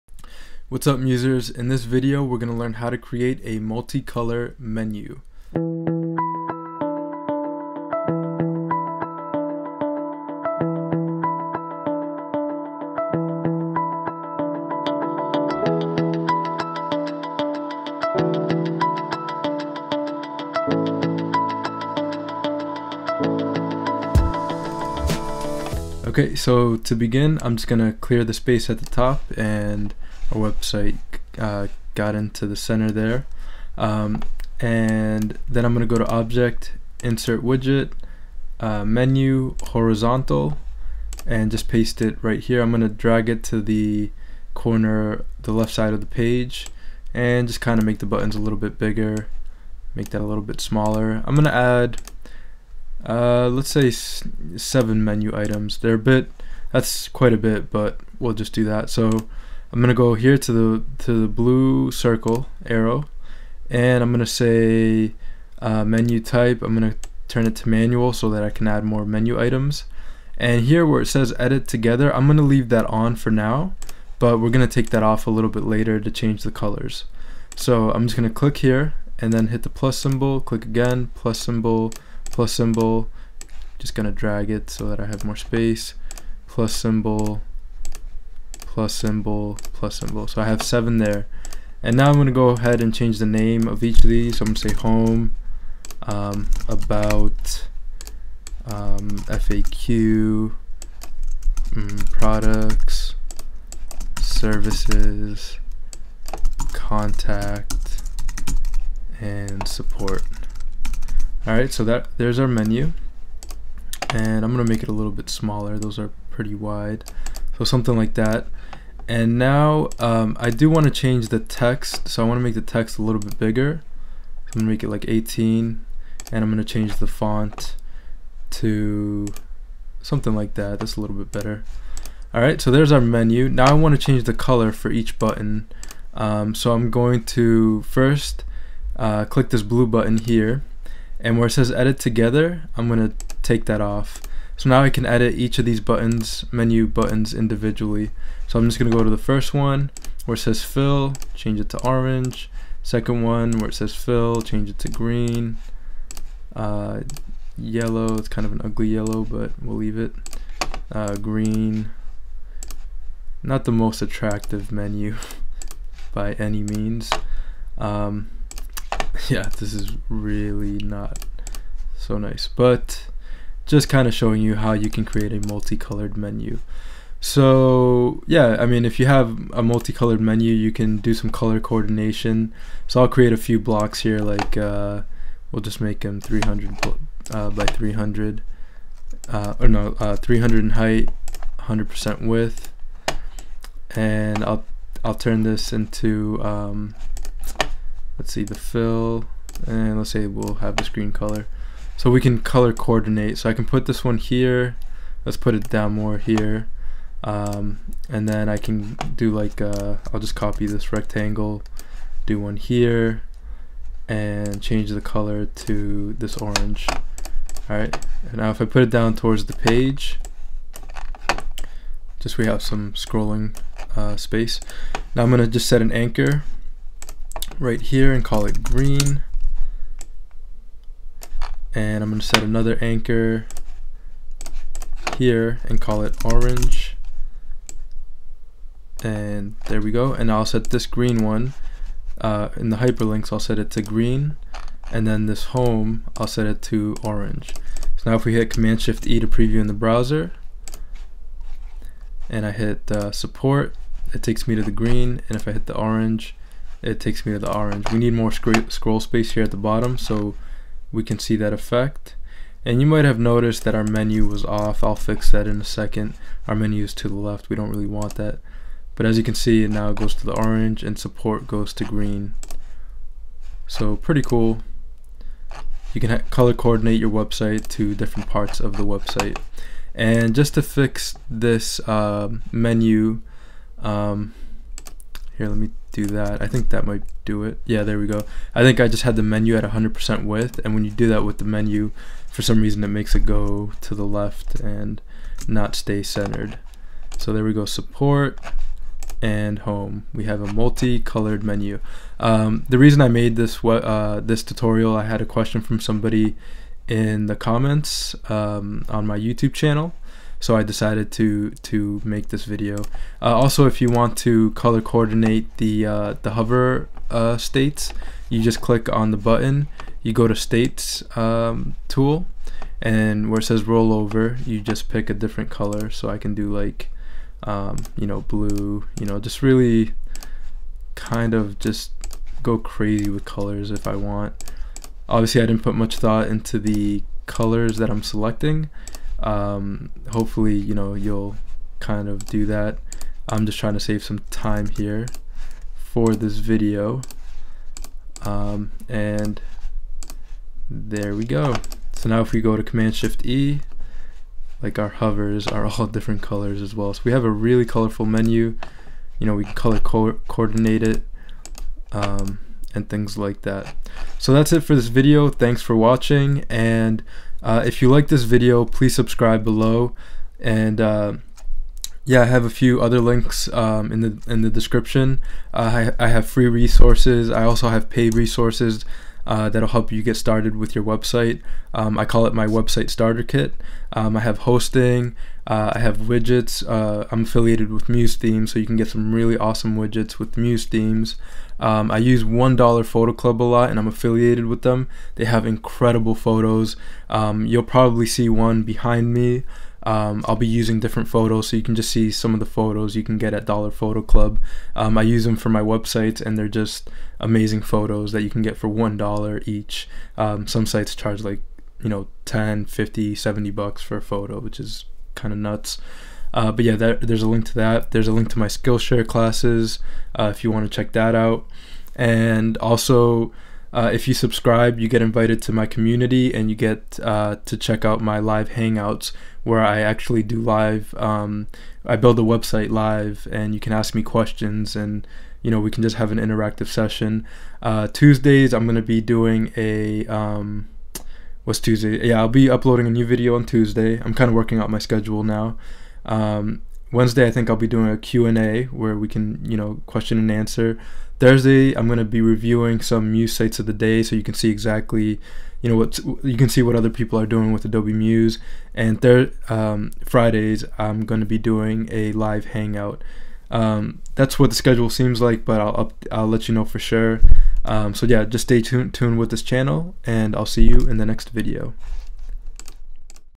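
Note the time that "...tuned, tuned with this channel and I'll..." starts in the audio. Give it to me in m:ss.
7:48.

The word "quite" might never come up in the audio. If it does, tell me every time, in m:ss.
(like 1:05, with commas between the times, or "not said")
0:57.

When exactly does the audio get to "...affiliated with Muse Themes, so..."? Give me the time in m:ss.
6:27.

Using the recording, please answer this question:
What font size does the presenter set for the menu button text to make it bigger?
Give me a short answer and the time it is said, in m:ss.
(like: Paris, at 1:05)
18, at 2:05.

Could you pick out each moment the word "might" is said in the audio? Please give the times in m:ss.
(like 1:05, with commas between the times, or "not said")
4:22, 4:46.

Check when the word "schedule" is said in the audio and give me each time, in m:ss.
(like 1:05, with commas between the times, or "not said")
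7:24, 7:44.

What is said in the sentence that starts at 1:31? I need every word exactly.
And now I'm gonna go ahead and change the name of each of these.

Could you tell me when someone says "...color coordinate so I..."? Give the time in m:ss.
3:22.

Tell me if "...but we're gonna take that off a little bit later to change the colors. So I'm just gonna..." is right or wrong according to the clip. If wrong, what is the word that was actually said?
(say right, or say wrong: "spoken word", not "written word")
right.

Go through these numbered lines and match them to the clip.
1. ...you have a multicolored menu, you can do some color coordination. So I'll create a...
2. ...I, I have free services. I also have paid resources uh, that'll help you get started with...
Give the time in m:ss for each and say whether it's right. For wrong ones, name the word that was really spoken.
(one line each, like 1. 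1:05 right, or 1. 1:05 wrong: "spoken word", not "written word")
1. 2:58 right
2. 6:15 wrong: "resources", not "services".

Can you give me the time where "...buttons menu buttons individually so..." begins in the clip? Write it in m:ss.
2:25.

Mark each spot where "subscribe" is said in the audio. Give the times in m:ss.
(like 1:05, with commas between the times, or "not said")
6:08, 7:04.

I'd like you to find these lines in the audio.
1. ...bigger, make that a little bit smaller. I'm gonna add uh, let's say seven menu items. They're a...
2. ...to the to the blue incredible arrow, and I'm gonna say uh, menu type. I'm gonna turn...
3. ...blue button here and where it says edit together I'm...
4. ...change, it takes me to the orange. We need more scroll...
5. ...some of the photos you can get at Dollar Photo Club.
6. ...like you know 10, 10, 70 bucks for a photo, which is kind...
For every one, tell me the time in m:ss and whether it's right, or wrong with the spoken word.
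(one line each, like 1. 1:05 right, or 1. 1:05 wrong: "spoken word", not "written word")
1. 0:48 right
2. 1:00 wrong: "circle", not "incredible"
3. 2:19 right
4. 4:15 wrong: "orange", not "change"
5. 6:42 right
6. 6:51 wrong: "50", not "10".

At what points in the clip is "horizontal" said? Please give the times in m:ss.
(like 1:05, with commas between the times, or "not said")
0:39.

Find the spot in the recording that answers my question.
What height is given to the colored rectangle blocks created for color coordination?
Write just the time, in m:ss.
3:10.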